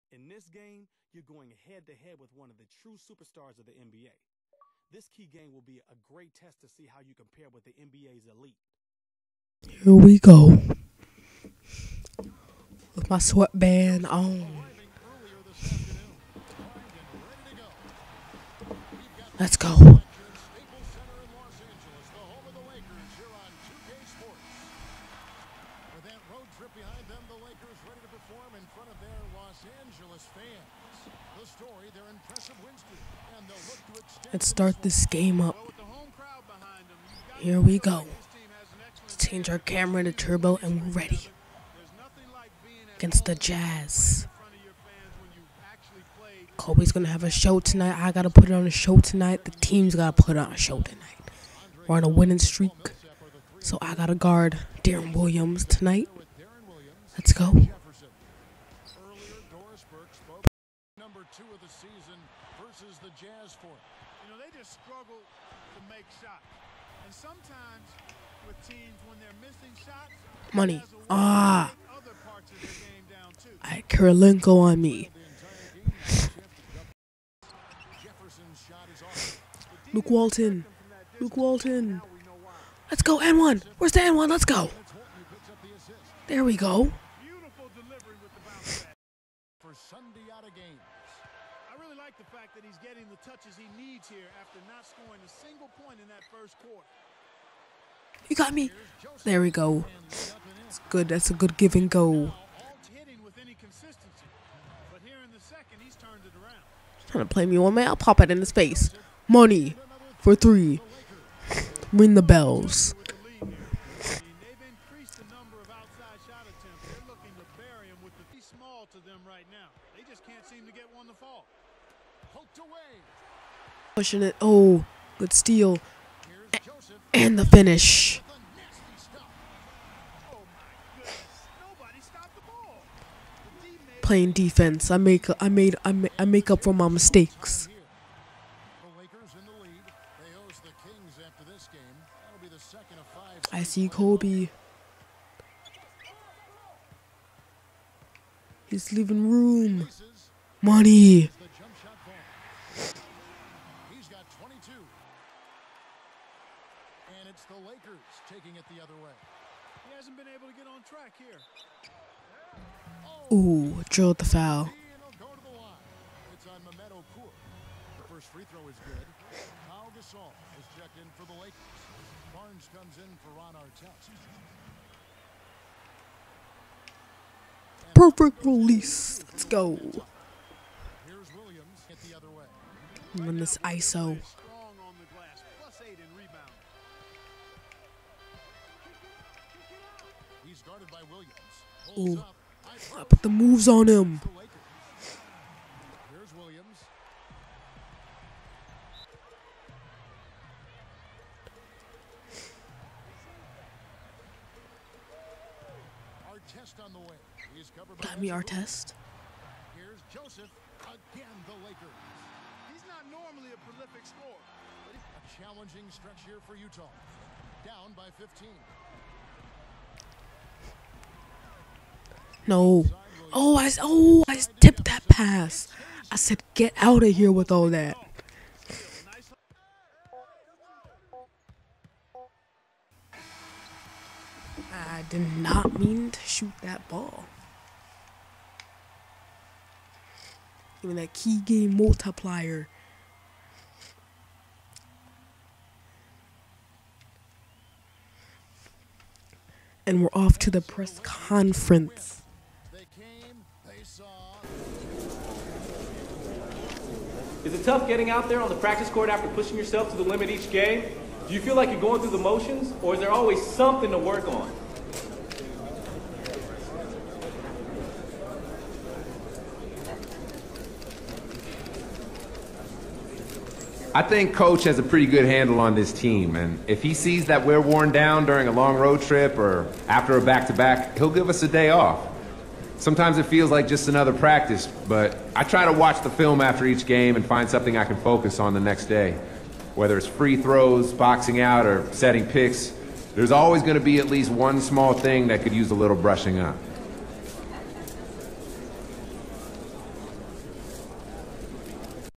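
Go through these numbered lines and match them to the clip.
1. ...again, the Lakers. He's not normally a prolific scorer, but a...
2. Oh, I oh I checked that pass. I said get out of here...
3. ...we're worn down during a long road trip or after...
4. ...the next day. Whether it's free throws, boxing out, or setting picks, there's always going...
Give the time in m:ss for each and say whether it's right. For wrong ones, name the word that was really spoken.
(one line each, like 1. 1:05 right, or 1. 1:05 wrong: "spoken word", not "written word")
1. 3:31 right
2. 3:43 wrong: "tipped", not "checked"
3. 4:37 right
4. 4:48 right.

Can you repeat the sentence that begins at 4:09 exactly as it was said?
And we're off to the press conference.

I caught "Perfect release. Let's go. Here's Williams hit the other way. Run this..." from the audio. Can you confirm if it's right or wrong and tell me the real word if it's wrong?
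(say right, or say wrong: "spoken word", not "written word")
right.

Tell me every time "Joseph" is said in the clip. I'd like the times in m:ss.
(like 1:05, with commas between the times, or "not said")
3:30.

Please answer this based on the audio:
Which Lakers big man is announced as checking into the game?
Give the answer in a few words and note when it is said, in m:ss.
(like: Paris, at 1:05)
Pau Gasol, at 2:49.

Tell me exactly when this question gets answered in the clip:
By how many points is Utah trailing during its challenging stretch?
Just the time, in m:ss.
3:38.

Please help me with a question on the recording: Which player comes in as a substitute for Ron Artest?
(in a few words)
Barnes.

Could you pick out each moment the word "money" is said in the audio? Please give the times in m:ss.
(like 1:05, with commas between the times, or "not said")
1:10, 1:49, 2:30.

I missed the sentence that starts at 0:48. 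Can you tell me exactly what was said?
I gotta put it on a show tonight.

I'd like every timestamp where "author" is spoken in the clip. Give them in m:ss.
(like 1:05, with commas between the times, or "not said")
not said.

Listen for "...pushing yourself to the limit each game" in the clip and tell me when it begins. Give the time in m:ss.
4:19.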